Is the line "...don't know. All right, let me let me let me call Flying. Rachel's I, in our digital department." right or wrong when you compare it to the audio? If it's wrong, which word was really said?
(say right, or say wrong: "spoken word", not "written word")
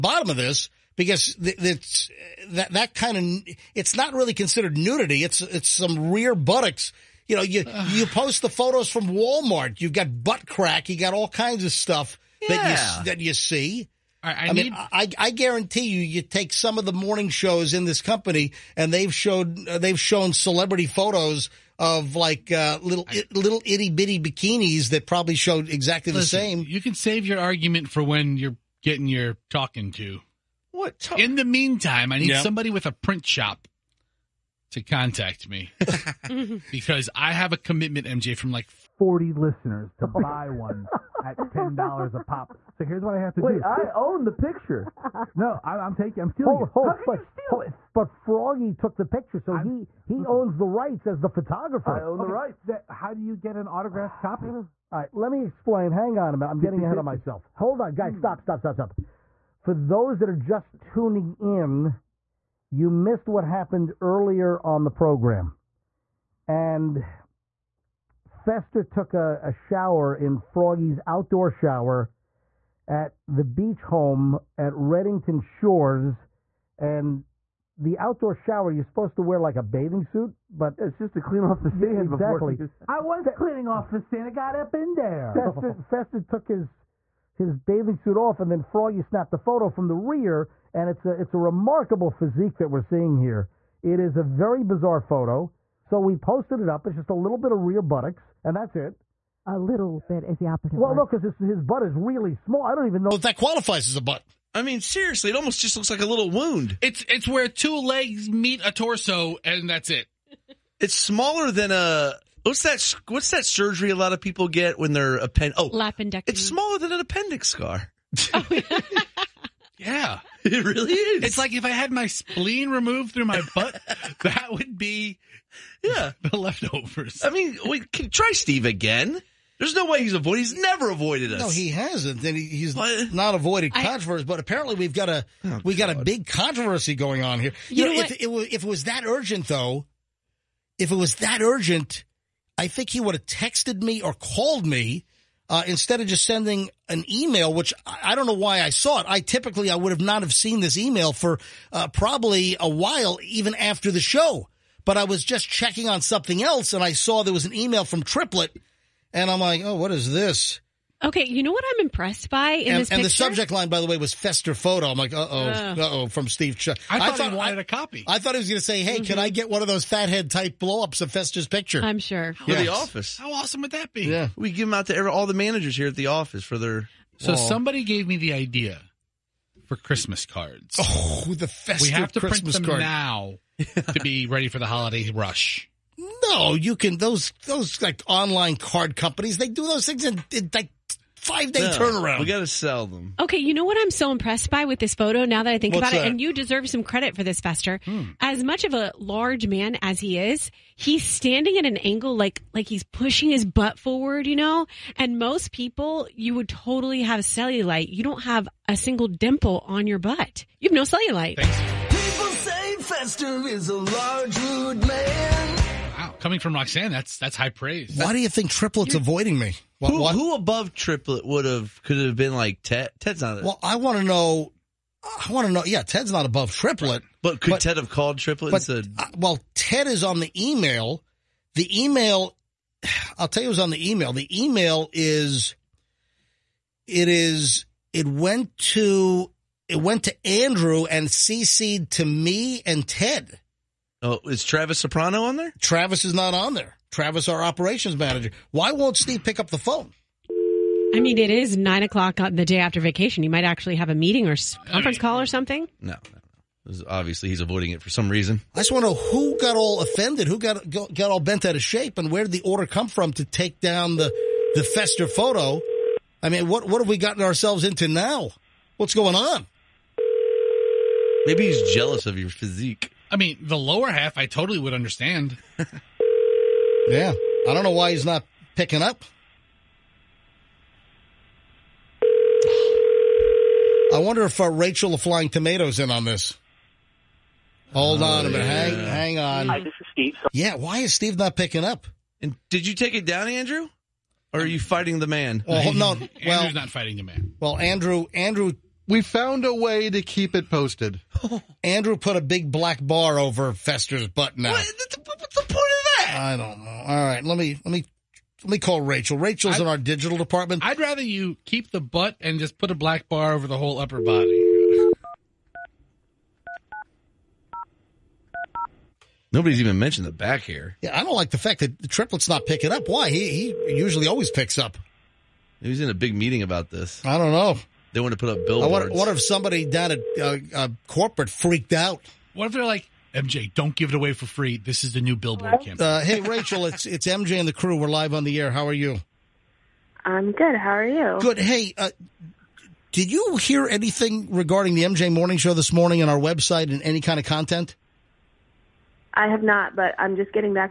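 wrong: "Rachel", not "Flying".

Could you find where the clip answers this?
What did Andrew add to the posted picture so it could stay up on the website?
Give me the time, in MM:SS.
05:02.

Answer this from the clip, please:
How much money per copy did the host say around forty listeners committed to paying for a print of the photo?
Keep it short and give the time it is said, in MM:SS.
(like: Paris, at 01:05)
$10, at 00:41.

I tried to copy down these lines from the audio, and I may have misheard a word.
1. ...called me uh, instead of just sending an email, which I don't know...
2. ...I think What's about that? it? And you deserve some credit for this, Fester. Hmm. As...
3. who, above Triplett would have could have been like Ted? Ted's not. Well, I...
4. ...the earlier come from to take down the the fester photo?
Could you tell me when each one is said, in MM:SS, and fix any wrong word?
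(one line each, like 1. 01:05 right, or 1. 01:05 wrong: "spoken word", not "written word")
1. 02:24 right
2. 03:15 right
3. 03:40 right
4. 04:22 wrong: "order", not "earlier".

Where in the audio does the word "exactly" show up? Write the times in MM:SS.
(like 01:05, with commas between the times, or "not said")
00:25, 01:22.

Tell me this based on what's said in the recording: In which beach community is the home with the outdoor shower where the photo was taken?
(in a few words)
Redington Shores.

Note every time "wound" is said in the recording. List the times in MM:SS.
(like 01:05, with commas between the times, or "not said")
01:46.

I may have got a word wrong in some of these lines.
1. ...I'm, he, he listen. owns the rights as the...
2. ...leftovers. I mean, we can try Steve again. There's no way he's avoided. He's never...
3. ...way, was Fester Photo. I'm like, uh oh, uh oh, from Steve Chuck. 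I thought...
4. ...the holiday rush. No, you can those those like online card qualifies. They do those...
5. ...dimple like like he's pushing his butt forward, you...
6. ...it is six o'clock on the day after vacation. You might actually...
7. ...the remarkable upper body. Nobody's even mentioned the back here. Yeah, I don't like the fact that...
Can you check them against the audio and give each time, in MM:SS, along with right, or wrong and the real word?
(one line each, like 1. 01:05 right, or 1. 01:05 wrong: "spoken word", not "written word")
1. 00:49 right
2. 02:06 right
3. 02:43 right
4. 03:04 wrong: "companies", not "qualifies"
5. 03:21 wrong: "angle", not "dimple"
6. 04:11 wrong: "nine", not "six"
7. 05:13 wrong: "whole", not "remarkable".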